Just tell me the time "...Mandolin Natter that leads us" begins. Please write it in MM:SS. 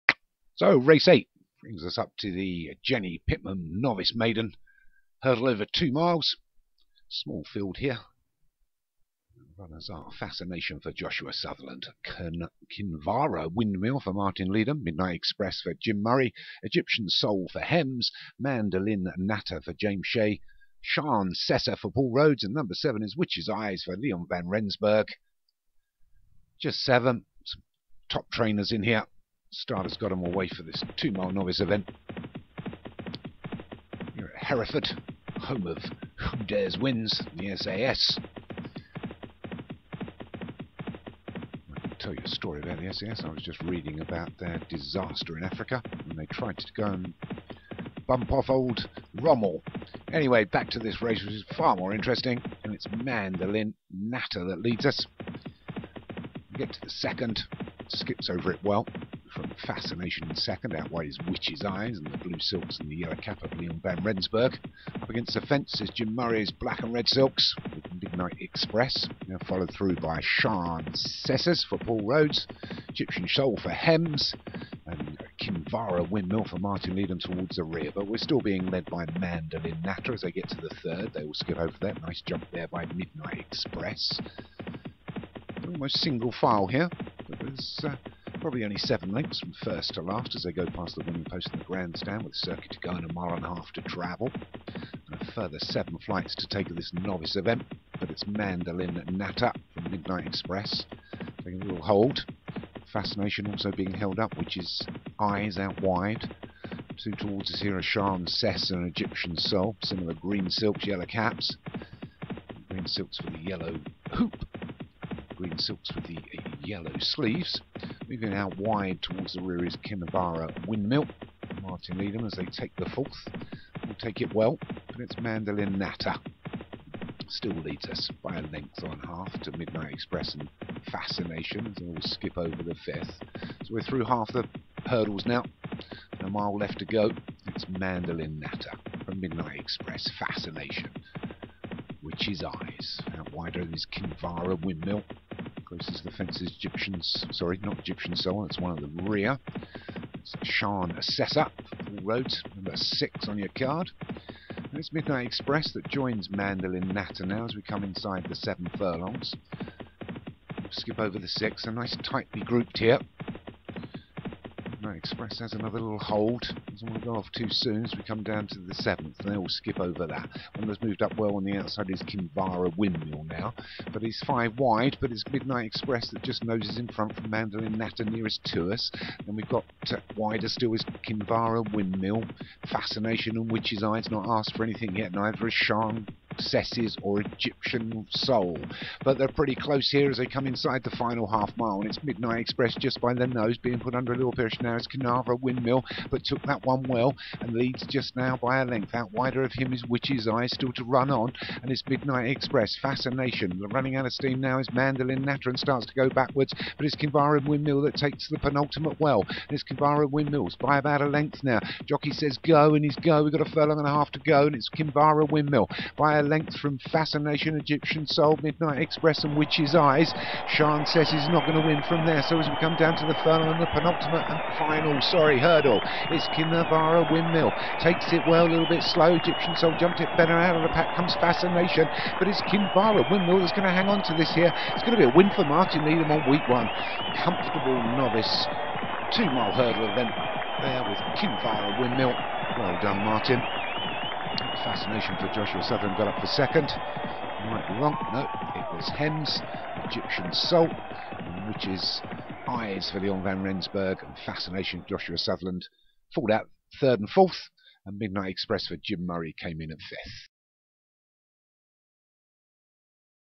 00:53.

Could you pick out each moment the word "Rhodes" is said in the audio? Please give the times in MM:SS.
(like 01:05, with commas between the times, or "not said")
00:22, 01:12.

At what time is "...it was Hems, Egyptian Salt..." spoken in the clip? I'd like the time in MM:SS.
04:08.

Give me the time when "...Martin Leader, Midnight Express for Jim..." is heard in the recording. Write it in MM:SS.
00:14.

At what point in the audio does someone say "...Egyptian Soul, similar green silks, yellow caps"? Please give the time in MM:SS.
01:48.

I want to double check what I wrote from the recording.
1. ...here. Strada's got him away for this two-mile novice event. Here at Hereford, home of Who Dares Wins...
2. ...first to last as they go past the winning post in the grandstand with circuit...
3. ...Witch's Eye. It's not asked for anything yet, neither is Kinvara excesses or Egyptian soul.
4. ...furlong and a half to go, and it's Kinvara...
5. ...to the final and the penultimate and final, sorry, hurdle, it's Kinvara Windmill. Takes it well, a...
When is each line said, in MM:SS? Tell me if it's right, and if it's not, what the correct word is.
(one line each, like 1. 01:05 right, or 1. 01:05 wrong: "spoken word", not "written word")
1. 00:28 right
2. 01:29 right
3. 03:03 wrong: "Shan", not "Kinvara"
4. 03:33 right
5. 03:42 right.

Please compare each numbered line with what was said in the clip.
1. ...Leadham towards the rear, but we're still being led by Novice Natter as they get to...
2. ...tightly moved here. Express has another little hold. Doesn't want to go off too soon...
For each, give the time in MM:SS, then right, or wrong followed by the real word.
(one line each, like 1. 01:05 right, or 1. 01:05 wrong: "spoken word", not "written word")
1. 01:16 wrong: "Mandolin", not "Novice"
2. 02:42 wrong: "grouped", not "moved".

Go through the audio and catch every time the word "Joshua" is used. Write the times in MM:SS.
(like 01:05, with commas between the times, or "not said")
00:10, 04:05, 04:14.